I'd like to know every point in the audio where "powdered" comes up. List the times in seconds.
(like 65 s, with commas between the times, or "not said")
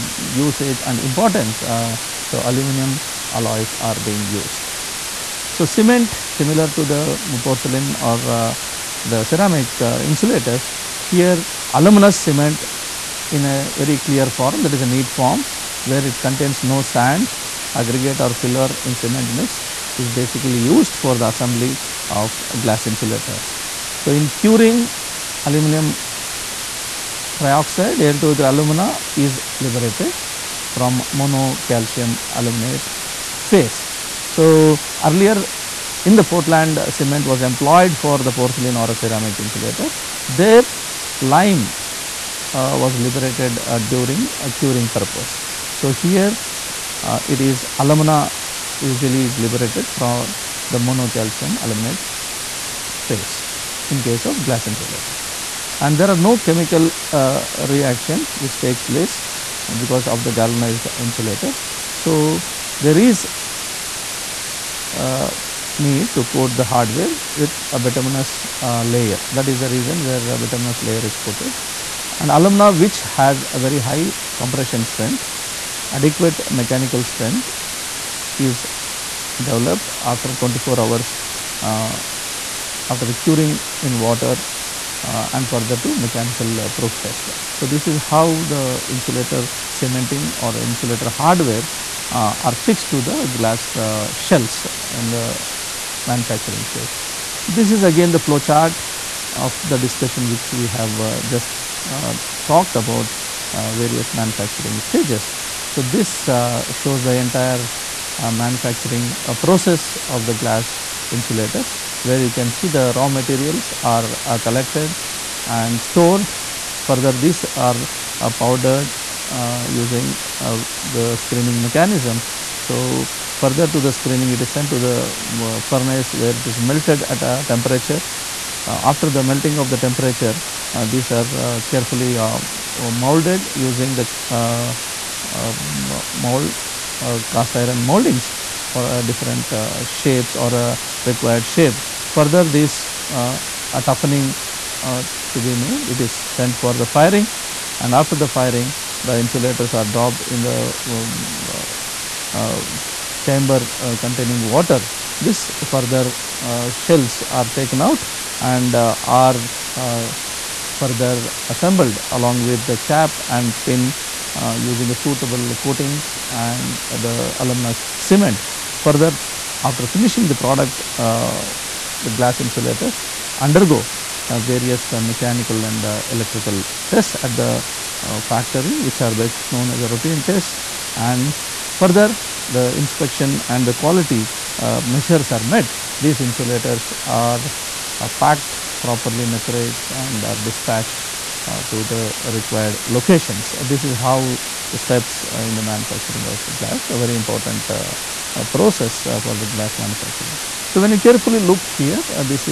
118 s.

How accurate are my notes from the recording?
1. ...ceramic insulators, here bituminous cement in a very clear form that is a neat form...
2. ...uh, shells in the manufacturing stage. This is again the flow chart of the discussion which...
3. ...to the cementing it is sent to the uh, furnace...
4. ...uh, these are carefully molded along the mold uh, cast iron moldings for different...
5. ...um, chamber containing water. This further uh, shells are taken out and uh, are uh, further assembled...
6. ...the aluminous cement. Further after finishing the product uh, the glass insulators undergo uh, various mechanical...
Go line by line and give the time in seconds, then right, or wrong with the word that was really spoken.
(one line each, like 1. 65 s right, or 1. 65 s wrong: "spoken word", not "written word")
1. 9 s wrong: "aluminous", not "bituminous"
2. 93 s right
3. 123 s wrong: "screening", not "cementing"
4. 130 s wrong: "using", not "along"
5. 152 s right
6. 166 s right.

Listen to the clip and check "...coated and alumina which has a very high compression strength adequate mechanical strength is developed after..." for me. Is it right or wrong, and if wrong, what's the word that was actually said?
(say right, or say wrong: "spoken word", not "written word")
right.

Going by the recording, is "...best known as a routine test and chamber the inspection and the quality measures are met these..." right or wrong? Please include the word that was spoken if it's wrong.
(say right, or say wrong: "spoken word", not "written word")
wrong: "further", not "chamber".